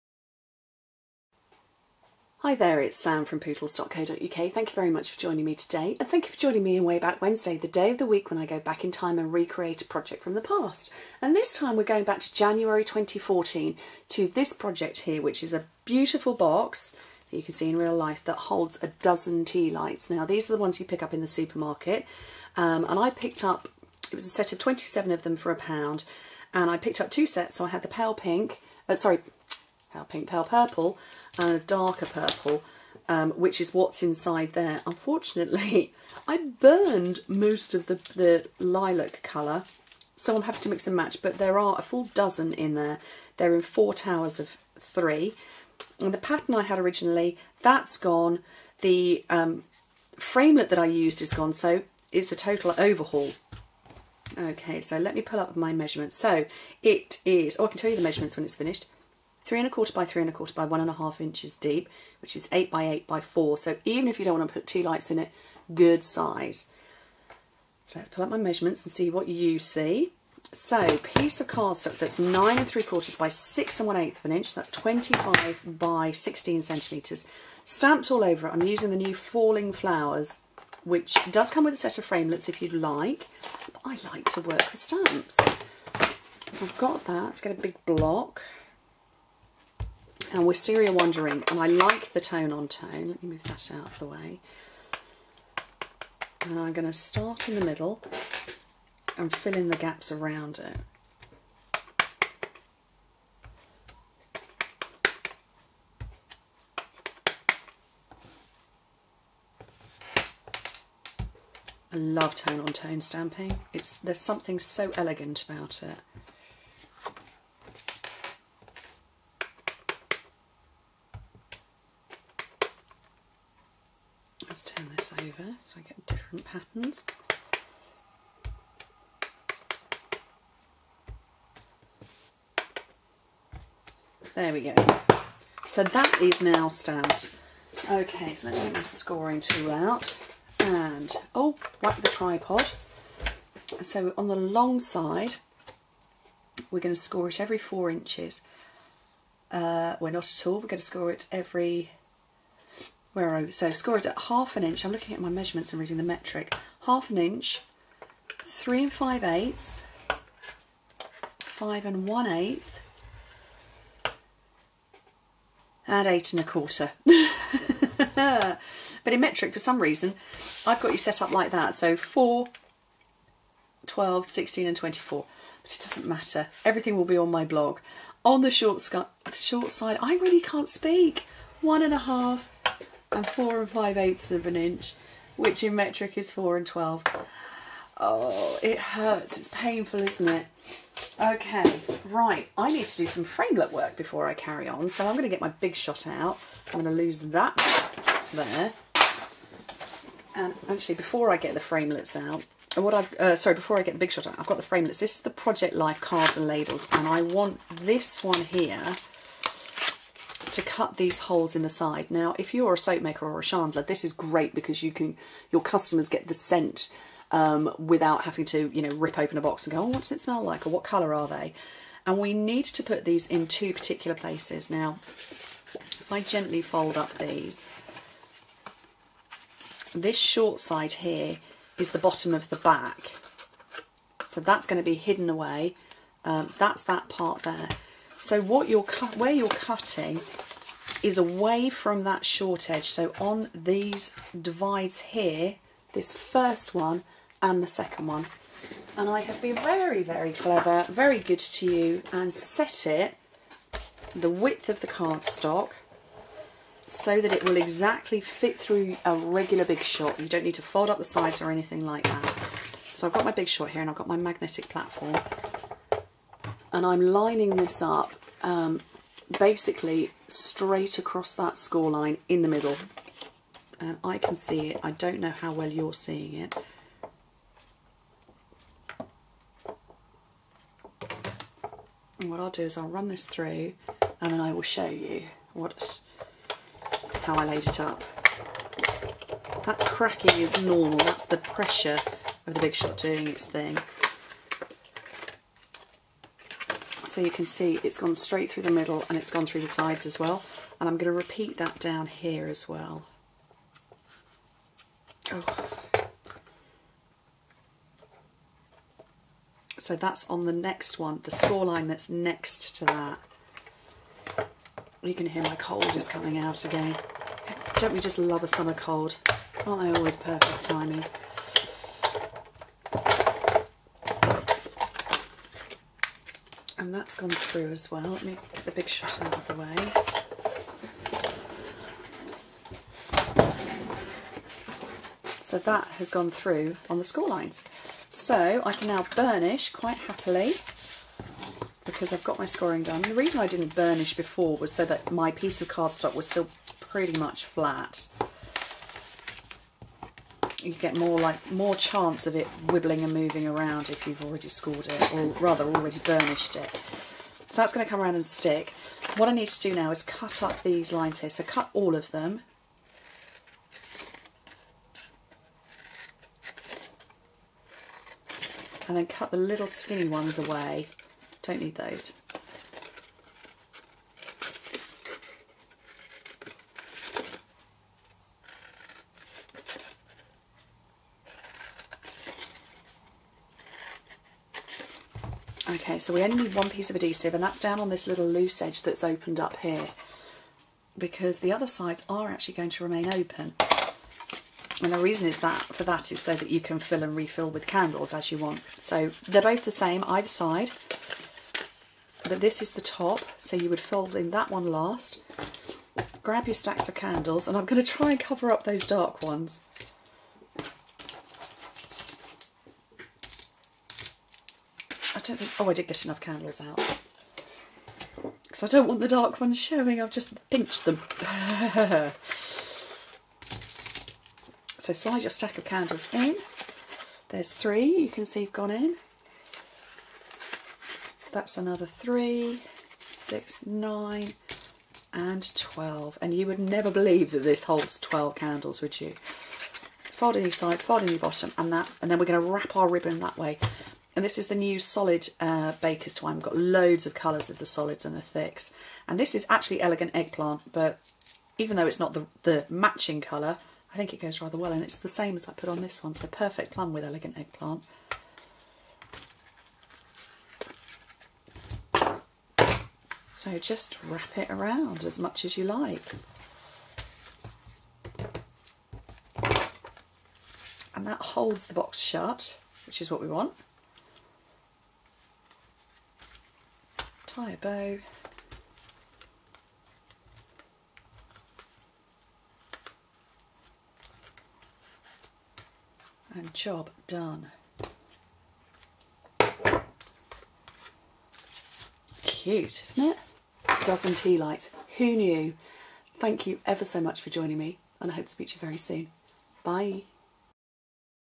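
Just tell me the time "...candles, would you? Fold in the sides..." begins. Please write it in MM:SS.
07:18.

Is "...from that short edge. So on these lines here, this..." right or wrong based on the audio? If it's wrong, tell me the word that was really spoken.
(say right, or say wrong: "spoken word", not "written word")
wrong: "divides", not "lines".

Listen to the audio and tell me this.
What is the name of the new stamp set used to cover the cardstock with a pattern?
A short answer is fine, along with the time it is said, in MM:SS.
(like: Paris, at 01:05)
Falling Flowers, at 01:19.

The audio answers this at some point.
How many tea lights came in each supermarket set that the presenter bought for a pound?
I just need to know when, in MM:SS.
00:24.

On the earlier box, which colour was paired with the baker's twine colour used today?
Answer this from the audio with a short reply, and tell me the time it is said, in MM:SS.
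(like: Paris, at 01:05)
Perfect Plum, at 07:36.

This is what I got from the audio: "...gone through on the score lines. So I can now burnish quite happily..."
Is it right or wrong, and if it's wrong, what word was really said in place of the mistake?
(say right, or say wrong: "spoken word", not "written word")
right.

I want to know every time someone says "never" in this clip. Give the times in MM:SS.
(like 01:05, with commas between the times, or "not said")
07:16.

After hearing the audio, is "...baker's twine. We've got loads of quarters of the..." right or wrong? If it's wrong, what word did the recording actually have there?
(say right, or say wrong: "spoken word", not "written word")
wrong: "colours", not "quarters".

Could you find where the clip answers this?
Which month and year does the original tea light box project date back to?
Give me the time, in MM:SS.
00:12.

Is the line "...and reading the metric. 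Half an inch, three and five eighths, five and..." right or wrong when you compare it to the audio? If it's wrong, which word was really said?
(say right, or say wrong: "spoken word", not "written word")
right.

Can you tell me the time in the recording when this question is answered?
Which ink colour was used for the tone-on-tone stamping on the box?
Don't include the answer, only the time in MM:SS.
01:30.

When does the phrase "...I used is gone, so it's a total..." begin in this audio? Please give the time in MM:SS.
00:50.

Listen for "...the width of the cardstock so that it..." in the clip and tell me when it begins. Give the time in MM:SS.
04:14.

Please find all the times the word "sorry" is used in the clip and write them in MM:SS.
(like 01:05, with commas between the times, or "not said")
00:28, 03:23.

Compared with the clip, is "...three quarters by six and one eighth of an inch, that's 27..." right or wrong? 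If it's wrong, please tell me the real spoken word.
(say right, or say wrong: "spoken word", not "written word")
wrong: "25", not "27".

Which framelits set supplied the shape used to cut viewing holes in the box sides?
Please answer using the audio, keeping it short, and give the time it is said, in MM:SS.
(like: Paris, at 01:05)
Project Life cards and labels, at 03:25.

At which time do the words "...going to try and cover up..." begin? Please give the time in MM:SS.
06:47.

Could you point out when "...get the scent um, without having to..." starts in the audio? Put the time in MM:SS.
03:36.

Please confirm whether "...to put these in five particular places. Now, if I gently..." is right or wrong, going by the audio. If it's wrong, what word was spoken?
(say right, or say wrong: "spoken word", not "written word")
wrong: "two", not "five".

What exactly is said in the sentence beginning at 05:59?
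What I need to do now is cut up these lines here.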